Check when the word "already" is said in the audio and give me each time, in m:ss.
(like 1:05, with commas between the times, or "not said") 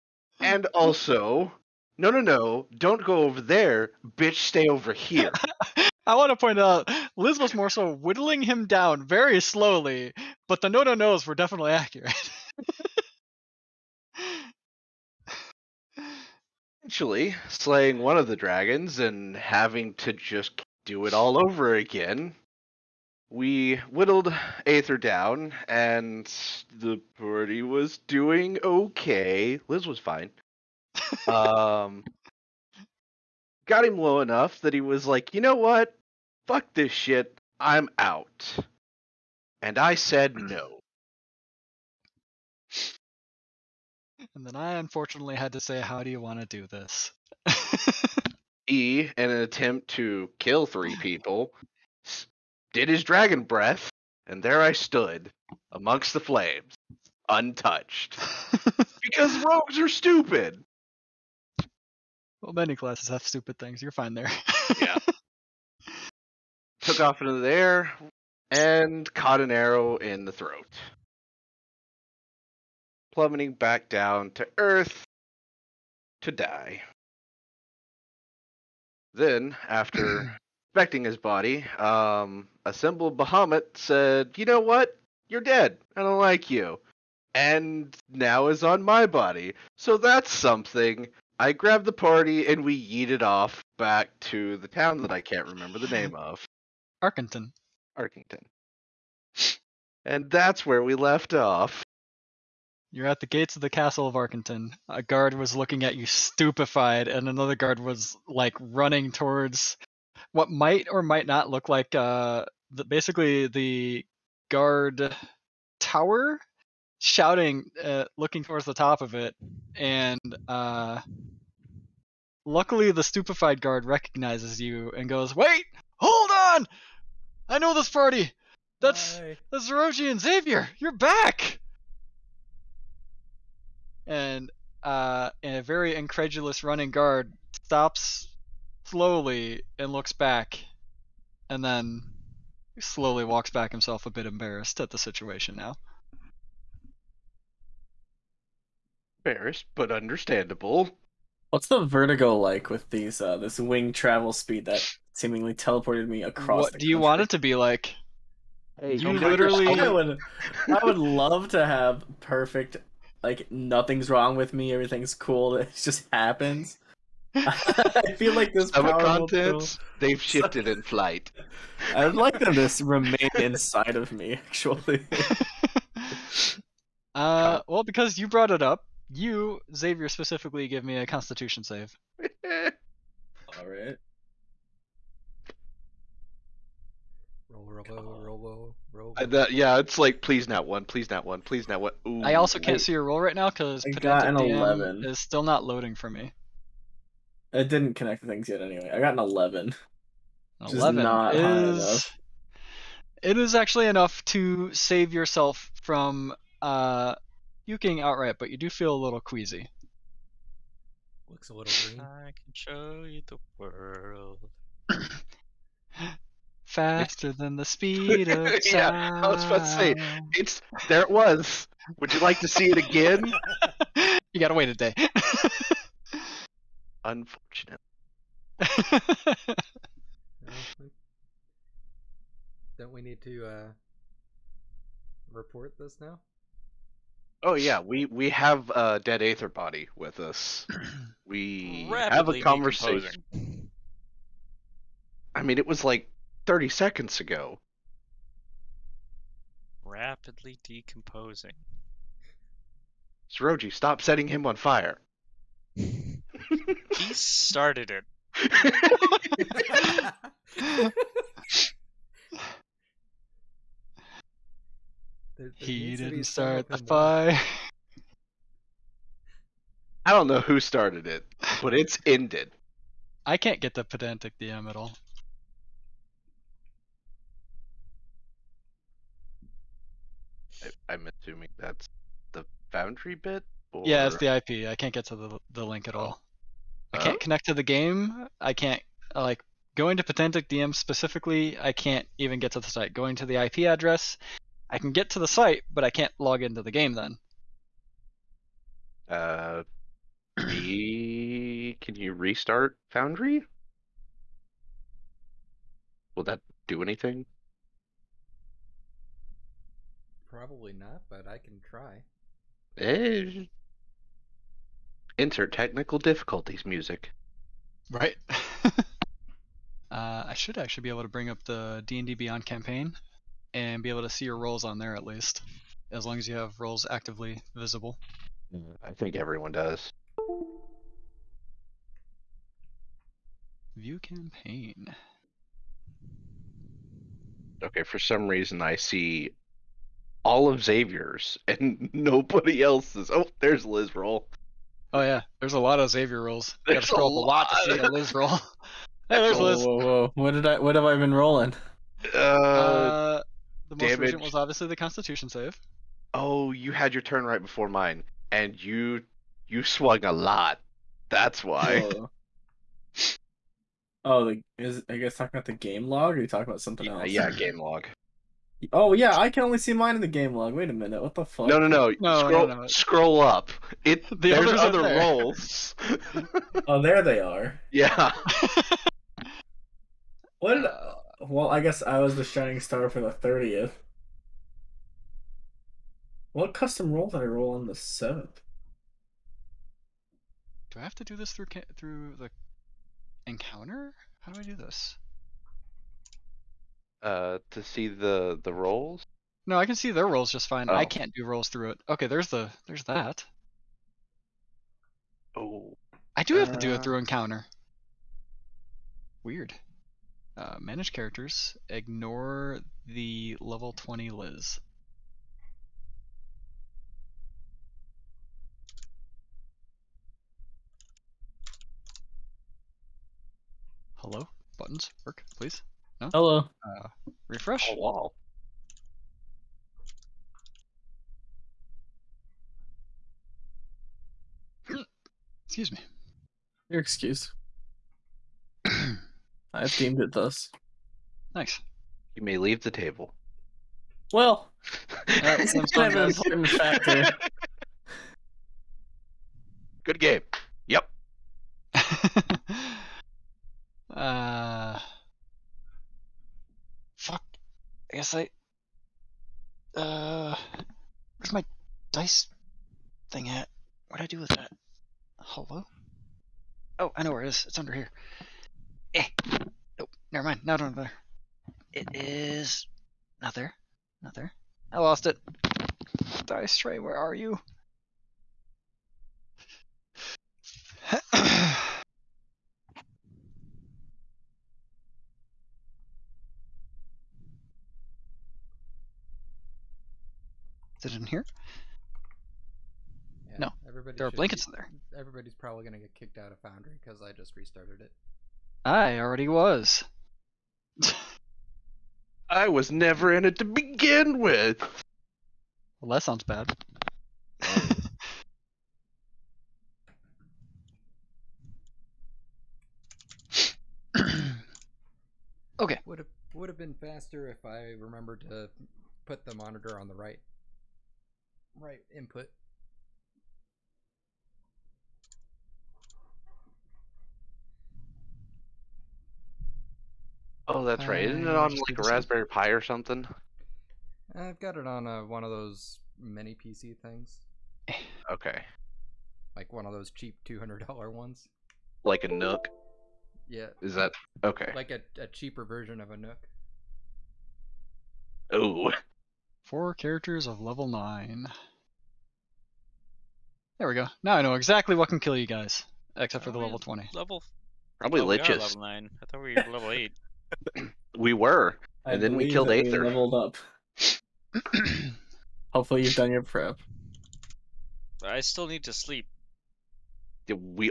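8:18.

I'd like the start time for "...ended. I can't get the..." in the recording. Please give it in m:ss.
4:32.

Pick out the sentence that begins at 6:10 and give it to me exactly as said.
Wait a minute, what the fuck?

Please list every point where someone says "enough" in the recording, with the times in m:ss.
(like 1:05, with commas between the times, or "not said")
0:34, 3:23.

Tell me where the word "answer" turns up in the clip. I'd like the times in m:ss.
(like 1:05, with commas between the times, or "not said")
not said.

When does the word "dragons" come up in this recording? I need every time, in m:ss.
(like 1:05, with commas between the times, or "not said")
0:18, 0:53.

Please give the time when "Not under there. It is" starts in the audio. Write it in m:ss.
7:50.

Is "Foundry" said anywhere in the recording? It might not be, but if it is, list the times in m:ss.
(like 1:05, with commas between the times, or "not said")
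5:02, 8:16.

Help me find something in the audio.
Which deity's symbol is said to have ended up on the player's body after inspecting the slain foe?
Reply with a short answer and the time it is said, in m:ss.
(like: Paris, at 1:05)
Bahamut, at 1:23.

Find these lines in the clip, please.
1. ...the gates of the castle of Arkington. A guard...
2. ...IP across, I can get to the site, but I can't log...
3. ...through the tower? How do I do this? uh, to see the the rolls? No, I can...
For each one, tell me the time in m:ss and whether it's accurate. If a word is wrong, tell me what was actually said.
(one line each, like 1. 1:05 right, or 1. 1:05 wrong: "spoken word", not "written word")
1. 1:43 right
2. 4:53 wrong: "address", not "across"
3. 6:31 wrong: "encounter", not "tower".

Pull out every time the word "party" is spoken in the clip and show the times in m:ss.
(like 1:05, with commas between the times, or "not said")
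0:27, 1:31, 2:07.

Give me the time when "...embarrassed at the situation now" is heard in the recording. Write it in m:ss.
2:24.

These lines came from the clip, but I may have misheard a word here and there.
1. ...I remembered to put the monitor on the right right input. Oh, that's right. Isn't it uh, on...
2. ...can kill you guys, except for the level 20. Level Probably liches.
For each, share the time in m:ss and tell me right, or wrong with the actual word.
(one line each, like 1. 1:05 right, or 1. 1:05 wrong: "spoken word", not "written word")
1. 8:37 right
2. 9:14 right.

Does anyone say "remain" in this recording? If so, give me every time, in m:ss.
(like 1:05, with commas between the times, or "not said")
2:52.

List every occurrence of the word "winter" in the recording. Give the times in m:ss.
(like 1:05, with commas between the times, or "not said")
not said.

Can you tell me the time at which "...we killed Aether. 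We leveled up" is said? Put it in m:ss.
9:22.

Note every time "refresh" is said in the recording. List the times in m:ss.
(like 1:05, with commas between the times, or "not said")
7:07.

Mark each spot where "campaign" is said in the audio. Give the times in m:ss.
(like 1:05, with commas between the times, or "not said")
5:22, 5:33.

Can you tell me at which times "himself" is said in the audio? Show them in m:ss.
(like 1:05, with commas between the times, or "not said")
2:23.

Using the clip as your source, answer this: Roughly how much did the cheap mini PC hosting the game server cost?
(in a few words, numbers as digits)
$200.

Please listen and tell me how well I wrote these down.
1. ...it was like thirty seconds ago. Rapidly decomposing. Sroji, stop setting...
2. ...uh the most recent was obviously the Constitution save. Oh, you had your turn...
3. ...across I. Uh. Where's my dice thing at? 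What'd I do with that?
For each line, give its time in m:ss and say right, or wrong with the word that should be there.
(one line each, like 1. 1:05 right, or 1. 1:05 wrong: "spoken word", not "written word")
1. 4:05 right
2. 5:52 right
3. 7:37 wrong: "guess", not "across".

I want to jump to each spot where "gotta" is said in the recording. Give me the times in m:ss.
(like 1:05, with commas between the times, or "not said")
3:44, 5:46.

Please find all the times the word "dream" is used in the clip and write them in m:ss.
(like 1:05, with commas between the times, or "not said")
not said.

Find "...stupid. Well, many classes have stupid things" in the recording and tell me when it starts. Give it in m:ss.
0:59.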